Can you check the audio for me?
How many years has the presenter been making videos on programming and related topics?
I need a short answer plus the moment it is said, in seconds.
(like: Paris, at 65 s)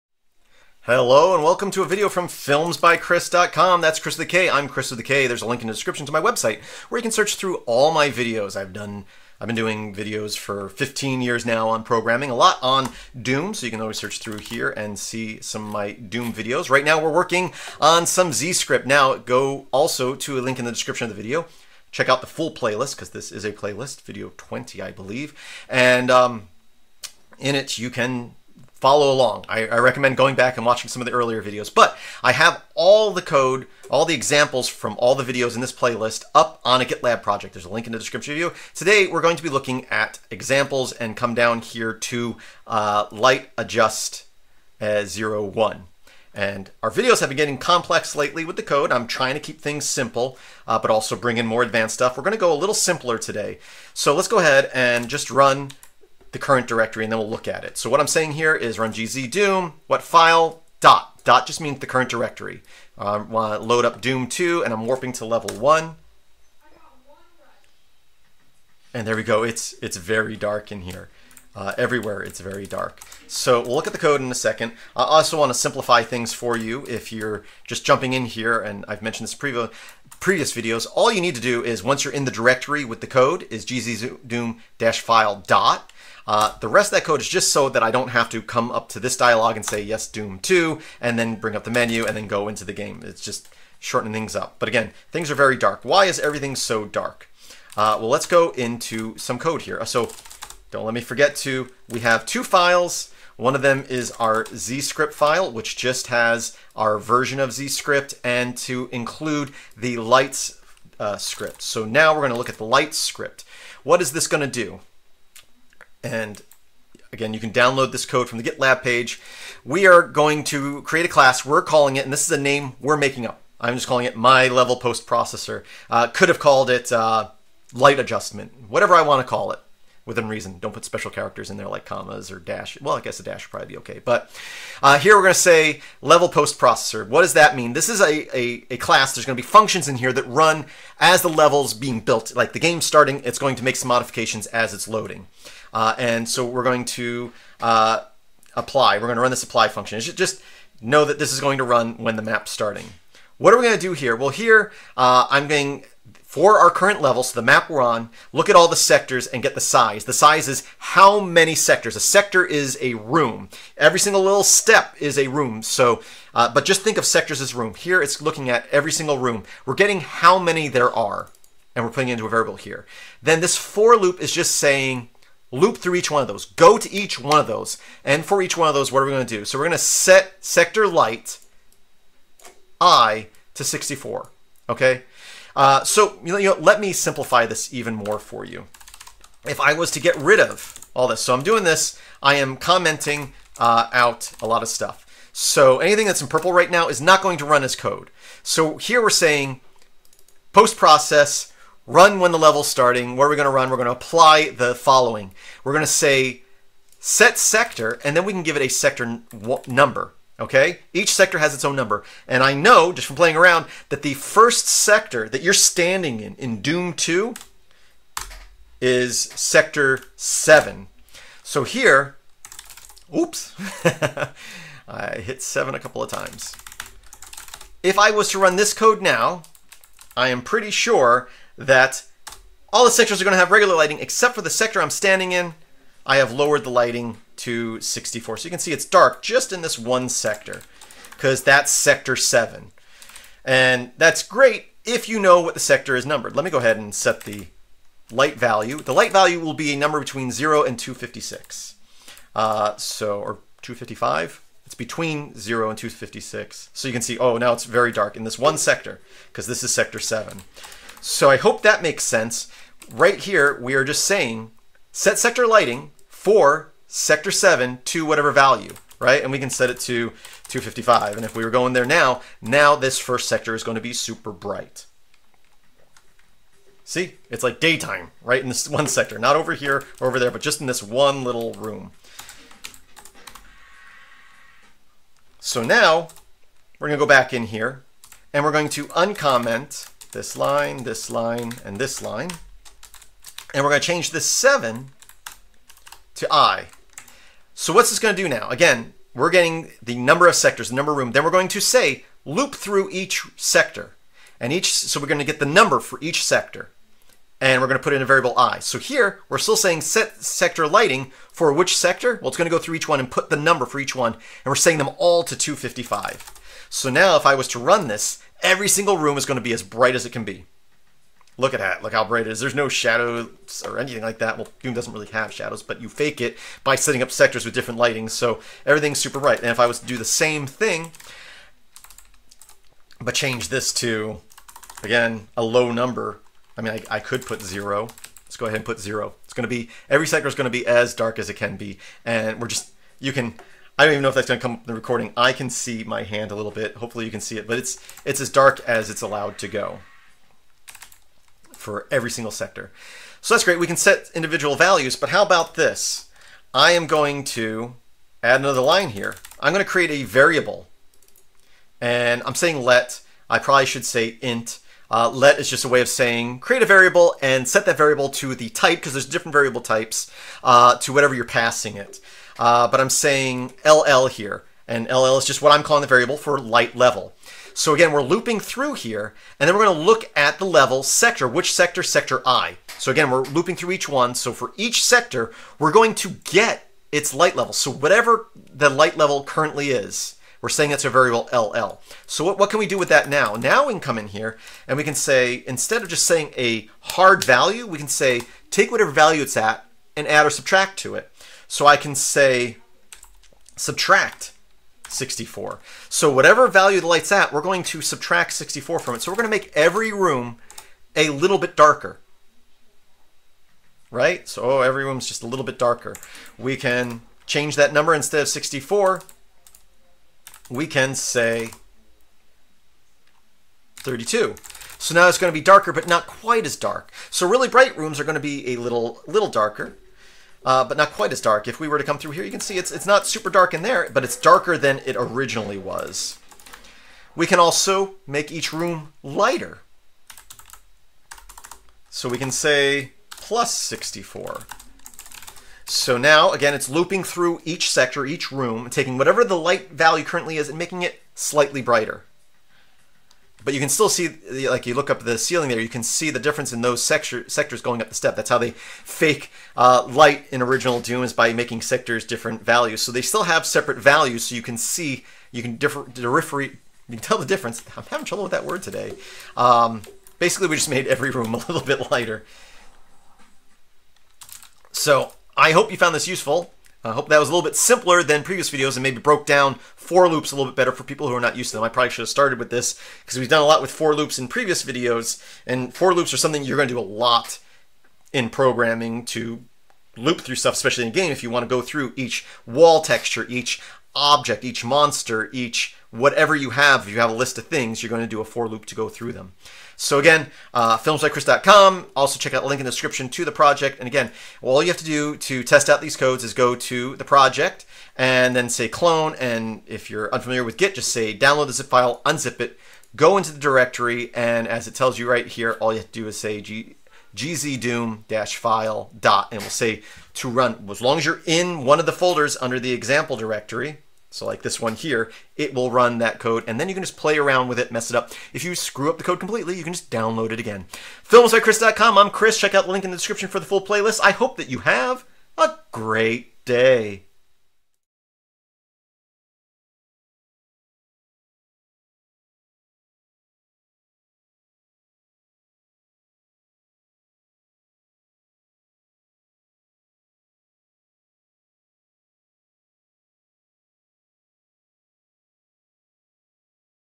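15, at 10 s.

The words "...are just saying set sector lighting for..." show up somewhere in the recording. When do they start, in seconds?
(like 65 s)
263 s.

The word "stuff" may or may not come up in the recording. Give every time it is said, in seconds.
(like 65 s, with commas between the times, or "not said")
51 s, 194 s, 490 s.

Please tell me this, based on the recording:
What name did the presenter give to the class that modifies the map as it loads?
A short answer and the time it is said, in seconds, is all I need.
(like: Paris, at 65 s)
my level post processor, at 124 s.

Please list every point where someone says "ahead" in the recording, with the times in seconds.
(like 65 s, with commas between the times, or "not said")
54 s, 246 s, 338 s.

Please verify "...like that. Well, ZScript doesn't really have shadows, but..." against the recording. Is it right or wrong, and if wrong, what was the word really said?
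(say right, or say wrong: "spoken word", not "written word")
wrong: "Doom", not "ZScript".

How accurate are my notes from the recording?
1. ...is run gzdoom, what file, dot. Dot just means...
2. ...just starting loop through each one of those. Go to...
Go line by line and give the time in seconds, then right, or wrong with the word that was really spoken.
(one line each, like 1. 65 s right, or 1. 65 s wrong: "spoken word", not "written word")
1. 58 s right
2. 174 s wrong: "saying", not "starting".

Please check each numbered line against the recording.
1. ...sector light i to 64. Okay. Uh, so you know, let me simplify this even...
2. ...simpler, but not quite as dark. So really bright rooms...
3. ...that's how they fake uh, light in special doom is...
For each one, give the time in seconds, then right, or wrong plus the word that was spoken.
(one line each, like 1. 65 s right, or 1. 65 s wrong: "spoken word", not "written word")
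1. 180 s right
2. 425 s wrong: "darker", not "simpler"
3. 458 s wrong: "original", not "special".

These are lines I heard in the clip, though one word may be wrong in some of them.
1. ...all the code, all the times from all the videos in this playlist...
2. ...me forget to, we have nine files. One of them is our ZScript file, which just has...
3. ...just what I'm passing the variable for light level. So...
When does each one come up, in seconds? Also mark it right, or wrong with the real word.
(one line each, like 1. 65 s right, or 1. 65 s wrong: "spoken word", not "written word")
1. 32 s wrong: "examples", not "times"
2. 100 s wrong: "two", not "nine"
3. 375 s wrong: "calling", not "passing".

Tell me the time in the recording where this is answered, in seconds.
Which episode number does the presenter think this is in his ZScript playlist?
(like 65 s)
24 s.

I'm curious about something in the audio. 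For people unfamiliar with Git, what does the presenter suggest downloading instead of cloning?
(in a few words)
the zip file.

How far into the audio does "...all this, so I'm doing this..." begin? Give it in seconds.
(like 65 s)
190 s.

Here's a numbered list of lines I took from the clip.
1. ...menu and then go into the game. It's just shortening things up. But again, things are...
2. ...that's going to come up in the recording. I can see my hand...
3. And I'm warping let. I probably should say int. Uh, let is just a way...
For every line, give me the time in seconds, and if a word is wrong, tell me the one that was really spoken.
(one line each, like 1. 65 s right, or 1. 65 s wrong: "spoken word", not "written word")
1. 91 s right
2. 344 s right
3. 361 s wrong: "saying", not "warping".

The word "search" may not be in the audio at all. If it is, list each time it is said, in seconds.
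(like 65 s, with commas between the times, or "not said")
7 s, 13 s.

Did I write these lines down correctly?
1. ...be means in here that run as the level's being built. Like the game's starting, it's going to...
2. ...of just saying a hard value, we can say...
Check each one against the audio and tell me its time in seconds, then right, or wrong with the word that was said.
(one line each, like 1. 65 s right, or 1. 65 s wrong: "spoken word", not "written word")
1. 139 s wrong: "functions", not "means"
2. 395 s right.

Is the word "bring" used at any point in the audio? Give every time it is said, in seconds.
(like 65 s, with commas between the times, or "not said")
51 s, 91 s.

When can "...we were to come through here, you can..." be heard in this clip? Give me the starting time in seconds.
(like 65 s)
431 s.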